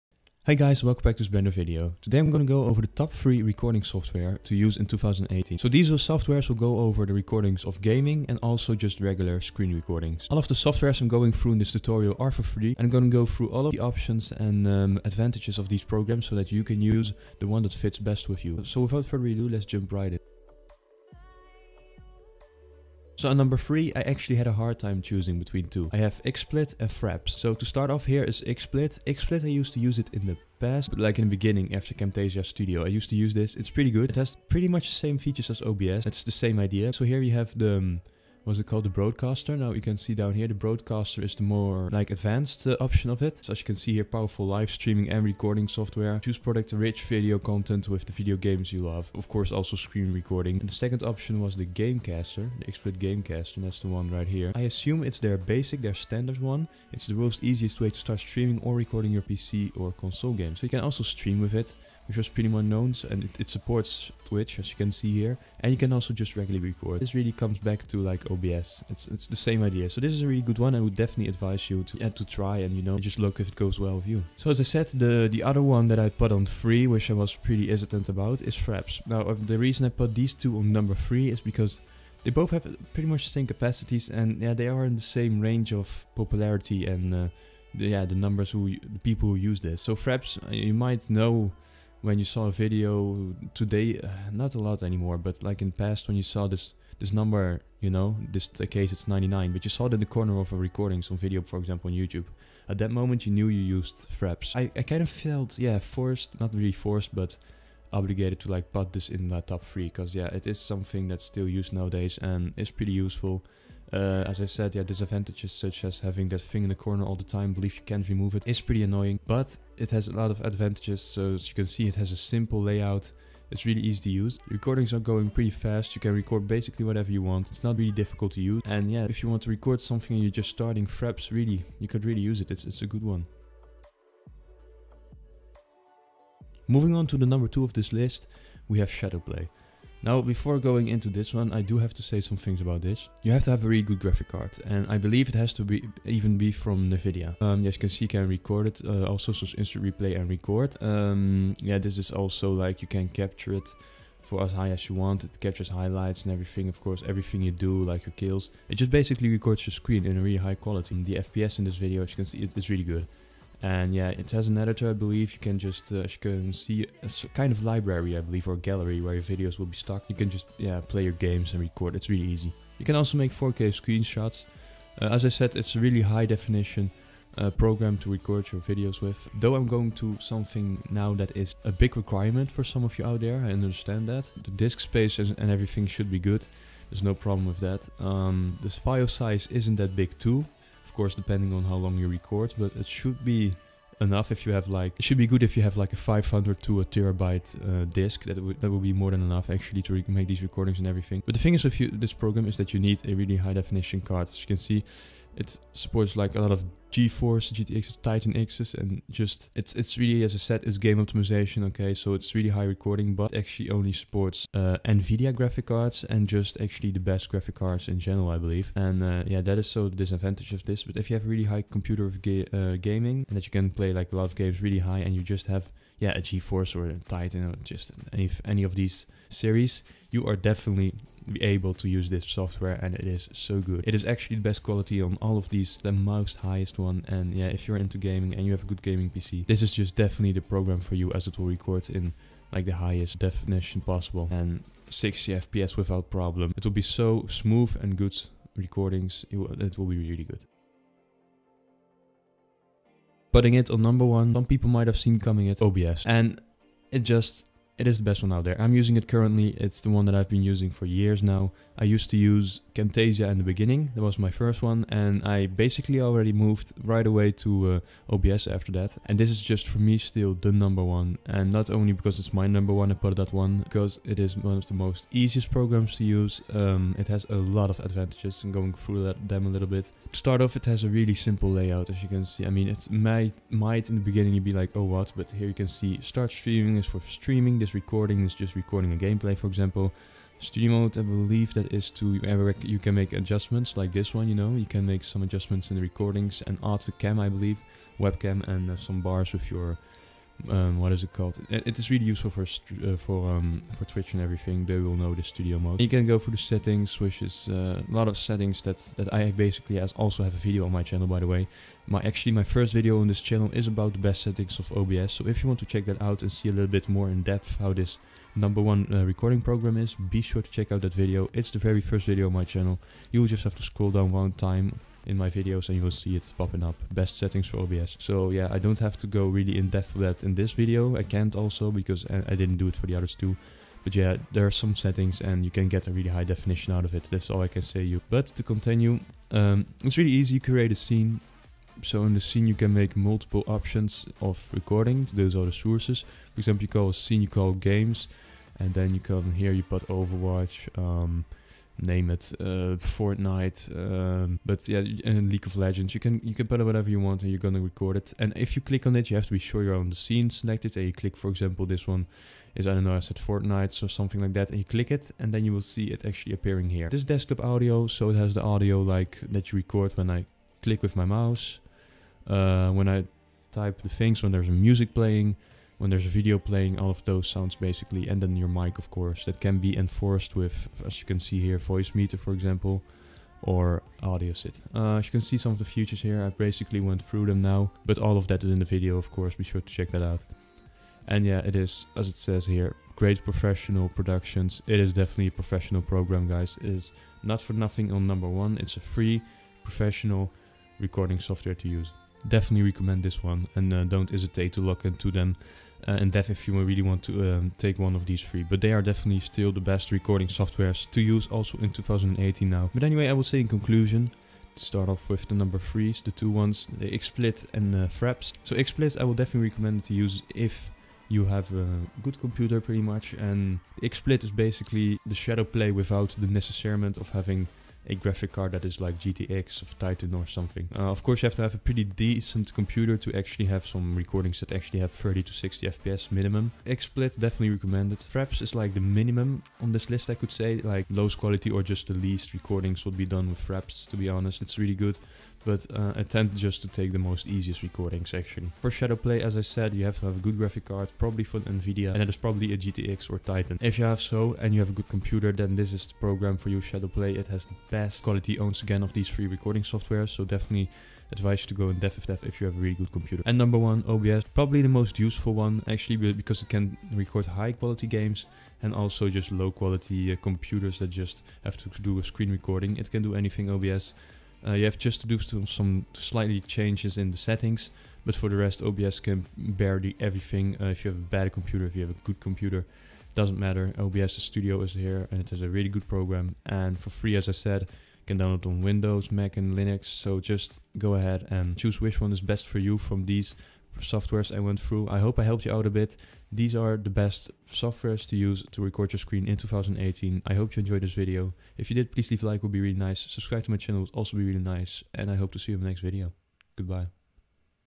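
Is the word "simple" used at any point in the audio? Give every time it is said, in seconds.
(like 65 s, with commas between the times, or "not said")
122 s, 281 s.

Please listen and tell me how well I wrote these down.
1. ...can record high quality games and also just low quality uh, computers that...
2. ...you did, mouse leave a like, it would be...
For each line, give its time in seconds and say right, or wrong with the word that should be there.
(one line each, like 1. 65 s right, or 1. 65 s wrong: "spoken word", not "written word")
1. 466 s right
2. 501 s wrong: "please", not "mouse".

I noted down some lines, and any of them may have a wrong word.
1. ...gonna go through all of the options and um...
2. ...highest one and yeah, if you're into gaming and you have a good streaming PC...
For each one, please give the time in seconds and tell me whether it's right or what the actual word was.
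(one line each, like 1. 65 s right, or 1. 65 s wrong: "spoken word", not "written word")
1. 12 s right
2. 236 s wrong: "gaming", not "streaming".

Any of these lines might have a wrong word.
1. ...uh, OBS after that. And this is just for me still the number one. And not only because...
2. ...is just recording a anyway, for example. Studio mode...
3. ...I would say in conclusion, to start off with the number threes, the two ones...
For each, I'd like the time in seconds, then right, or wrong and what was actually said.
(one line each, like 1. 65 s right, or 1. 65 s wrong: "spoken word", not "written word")
1. 268 s right
2. 288 s wrong: "gameplay", not "anyway"
3. 413 s right.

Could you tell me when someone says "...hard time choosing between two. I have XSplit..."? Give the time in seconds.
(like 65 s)
24 s.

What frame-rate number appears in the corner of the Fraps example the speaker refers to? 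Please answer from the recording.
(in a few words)
99.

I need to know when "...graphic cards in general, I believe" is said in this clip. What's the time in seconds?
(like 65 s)
217 s.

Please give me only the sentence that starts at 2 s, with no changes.
Today I'm gonna go over the top 3 recording software to use in 2018.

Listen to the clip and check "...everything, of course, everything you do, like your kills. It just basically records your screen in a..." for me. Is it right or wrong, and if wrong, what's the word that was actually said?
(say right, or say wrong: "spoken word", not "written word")
right.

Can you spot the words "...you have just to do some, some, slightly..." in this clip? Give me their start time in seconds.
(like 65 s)
474 s.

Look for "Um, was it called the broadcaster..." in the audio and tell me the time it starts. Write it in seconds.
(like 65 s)
37 s.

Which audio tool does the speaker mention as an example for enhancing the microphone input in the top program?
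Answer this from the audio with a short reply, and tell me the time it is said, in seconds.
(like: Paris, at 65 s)
Voicemeeter, at 381 s.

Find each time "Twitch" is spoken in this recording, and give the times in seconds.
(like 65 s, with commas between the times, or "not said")
64 s, 303 s.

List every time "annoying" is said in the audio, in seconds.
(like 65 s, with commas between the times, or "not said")
118 s.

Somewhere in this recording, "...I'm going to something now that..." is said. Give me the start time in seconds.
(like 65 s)
179 s.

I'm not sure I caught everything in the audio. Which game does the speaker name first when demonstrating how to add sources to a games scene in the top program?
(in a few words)
Overwatch.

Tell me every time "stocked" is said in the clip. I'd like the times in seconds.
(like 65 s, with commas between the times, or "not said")
169 s.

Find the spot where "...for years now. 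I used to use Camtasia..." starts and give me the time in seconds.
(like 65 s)
260 s.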